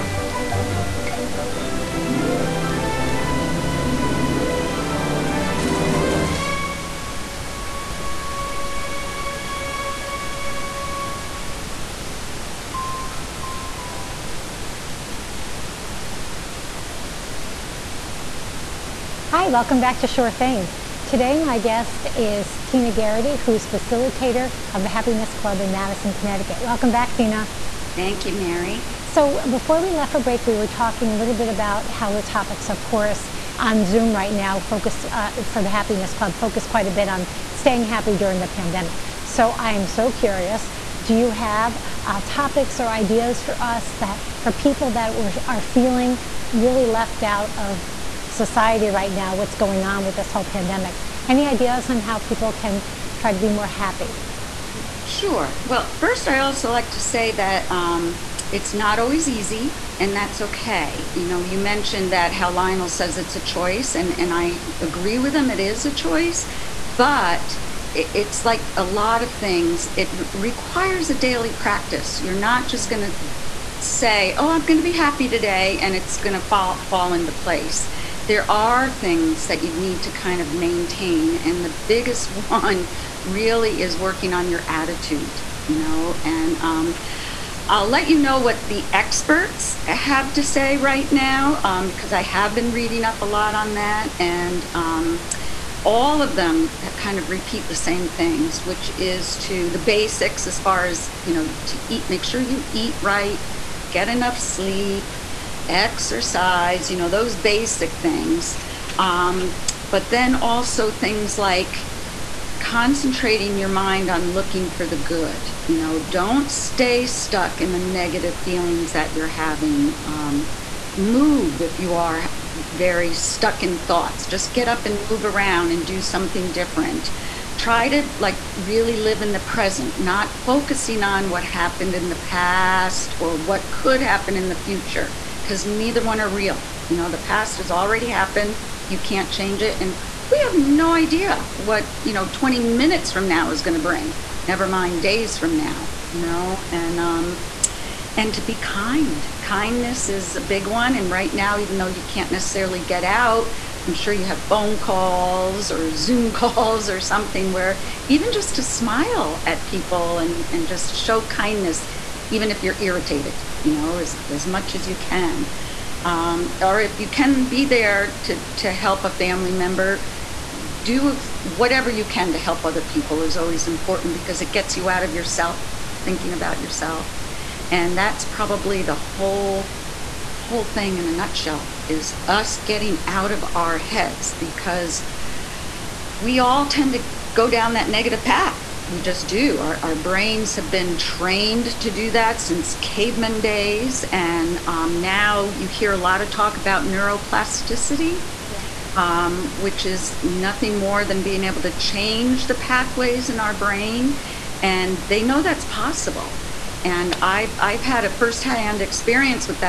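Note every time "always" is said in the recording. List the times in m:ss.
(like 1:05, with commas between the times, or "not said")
0:58, 2:53.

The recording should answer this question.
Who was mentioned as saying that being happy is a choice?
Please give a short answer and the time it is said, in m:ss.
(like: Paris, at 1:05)
Lionel, at 1:02.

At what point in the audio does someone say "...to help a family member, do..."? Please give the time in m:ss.
2:48.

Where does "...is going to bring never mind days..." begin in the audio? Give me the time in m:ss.
2:23.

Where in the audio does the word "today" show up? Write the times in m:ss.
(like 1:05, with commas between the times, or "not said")
0:21, 1:15.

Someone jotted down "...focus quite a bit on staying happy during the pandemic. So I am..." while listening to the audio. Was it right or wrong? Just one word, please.
right.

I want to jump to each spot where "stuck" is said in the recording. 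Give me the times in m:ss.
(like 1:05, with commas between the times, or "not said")
1:57, 2:03.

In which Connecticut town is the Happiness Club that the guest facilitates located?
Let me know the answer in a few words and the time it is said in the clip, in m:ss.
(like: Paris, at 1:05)
Madison, at 0:25.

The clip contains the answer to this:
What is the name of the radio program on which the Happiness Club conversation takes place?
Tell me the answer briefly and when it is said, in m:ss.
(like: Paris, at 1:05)
Shore Things, at 0:20.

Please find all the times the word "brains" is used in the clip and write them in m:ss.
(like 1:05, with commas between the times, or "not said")
3:09, 3:23.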